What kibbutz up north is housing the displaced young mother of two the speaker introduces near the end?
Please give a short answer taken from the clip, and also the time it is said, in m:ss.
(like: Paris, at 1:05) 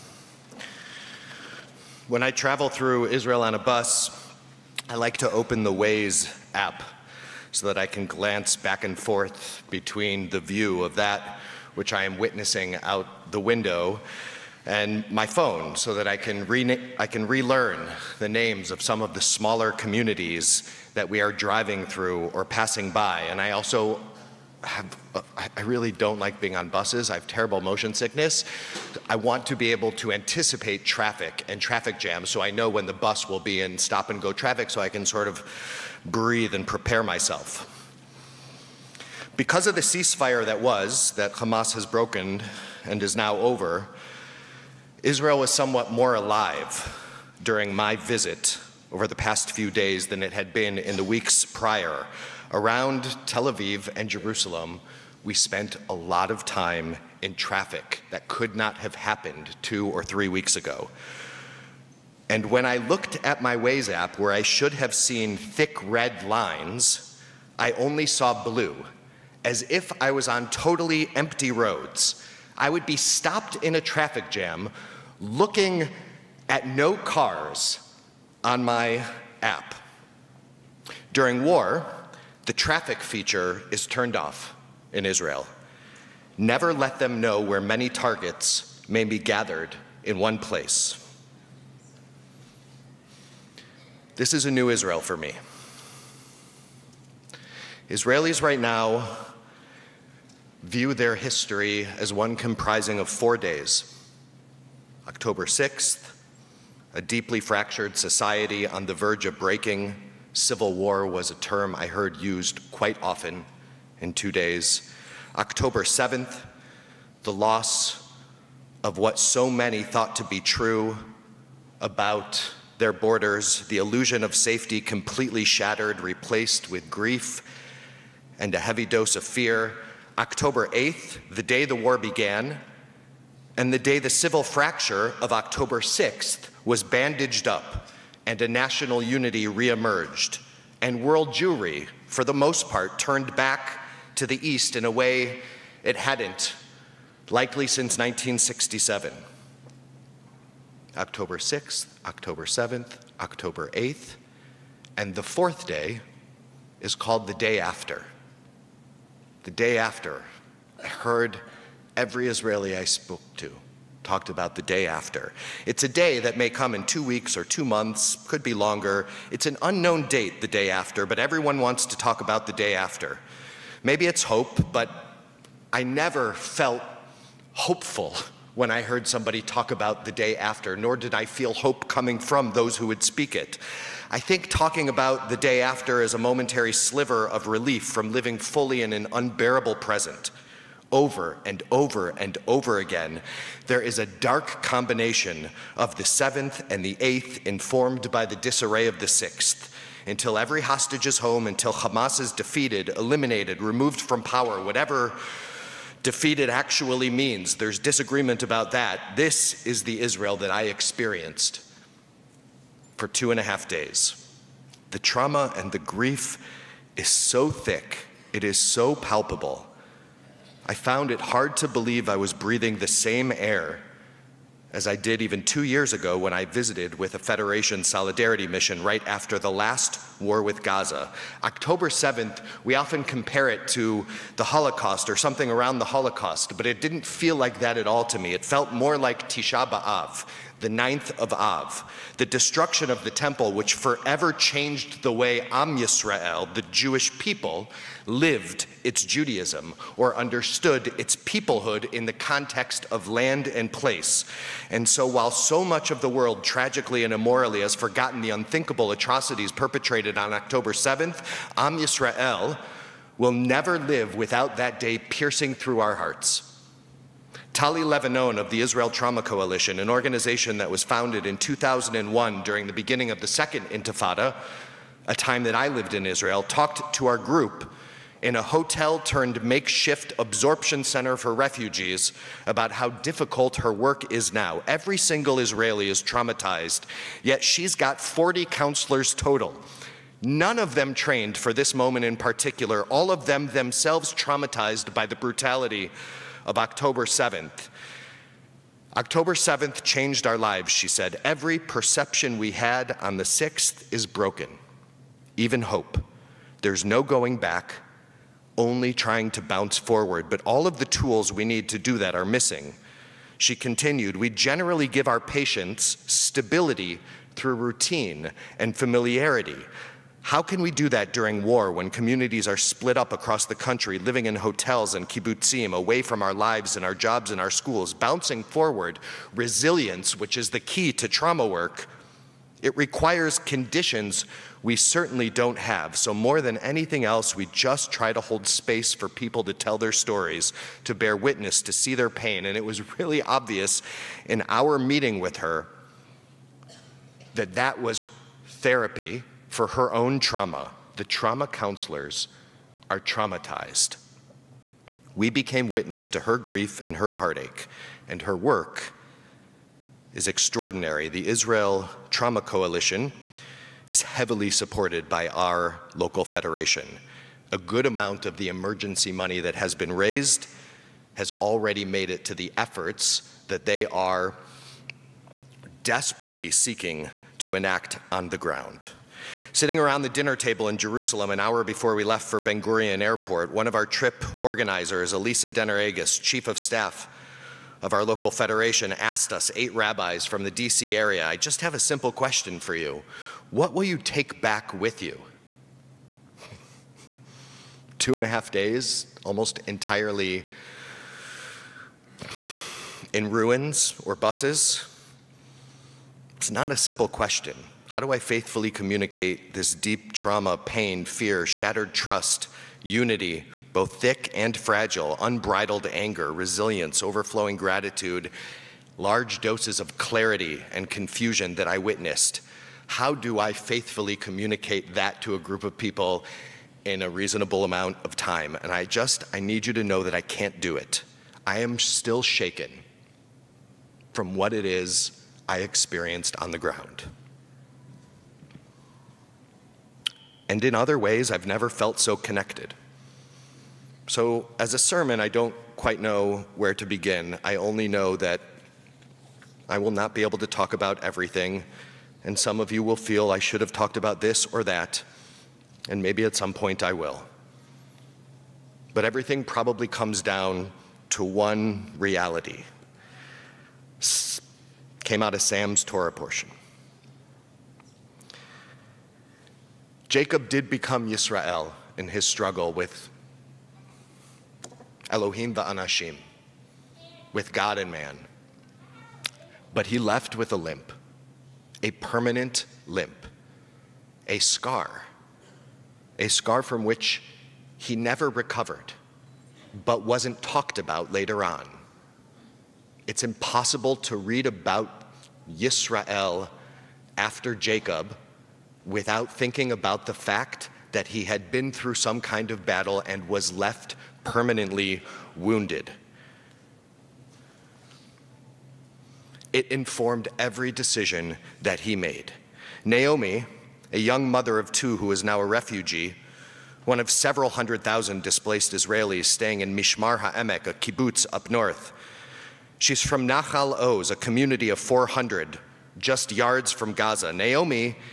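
Mishmar HaEmek, at 8:39.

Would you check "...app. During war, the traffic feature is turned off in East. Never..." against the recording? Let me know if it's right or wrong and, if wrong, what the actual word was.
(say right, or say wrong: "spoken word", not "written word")
wrong: "Israel", not "East".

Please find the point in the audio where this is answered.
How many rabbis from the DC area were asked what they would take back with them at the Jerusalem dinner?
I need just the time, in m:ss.
6:29.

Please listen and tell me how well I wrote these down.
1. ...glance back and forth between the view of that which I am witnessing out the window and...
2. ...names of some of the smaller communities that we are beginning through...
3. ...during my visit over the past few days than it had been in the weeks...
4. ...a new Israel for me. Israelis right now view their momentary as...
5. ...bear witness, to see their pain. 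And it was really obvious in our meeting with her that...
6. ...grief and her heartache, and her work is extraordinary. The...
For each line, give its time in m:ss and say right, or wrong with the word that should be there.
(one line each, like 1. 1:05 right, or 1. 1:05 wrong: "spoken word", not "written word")
1. 0:08 right
2. 0:18 wrong: "driving", not "beginning"
3. 0:47 right
4. 1:34 wrong: "history", not "momentary"
5. 5:40 right
6. 5:56 right.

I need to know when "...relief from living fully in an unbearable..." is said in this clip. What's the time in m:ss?
3:07.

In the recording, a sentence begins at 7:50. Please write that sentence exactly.
Jacob did become Yisrael in his struggle with Elohim Anashim, with God and man.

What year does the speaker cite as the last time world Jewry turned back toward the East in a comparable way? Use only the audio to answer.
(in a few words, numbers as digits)
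1967.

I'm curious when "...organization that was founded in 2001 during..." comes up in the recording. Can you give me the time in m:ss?
4:29.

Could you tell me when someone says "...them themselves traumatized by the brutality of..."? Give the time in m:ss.
4:53.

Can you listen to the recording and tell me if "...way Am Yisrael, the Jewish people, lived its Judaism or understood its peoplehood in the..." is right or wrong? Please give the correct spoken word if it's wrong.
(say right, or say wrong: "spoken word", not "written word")
right.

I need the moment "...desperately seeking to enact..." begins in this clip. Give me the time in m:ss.
6:15.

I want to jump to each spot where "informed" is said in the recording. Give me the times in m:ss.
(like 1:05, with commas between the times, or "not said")
3:17, 8:29.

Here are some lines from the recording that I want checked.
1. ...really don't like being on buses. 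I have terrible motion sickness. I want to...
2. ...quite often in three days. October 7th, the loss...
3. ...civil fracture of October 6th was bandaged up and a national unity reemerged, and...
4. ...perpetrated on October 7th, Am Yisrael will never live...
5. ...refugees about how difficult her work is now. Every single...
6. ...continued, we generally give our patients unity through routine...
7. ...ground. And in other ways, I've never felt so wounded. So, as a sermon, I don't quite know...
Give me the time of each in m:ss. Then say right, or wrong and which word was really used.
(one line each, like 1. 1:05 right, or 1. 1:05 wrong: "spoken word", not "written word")
1. 0:25 right
2. 1:52 wrong: "two", not "three"
3. 2:14 right
4. 4:19 right
5. 4:41 right
6. 5:13 wrong: "stability", not "unity"
7. 7:16 wrong: "connected", not "wounded".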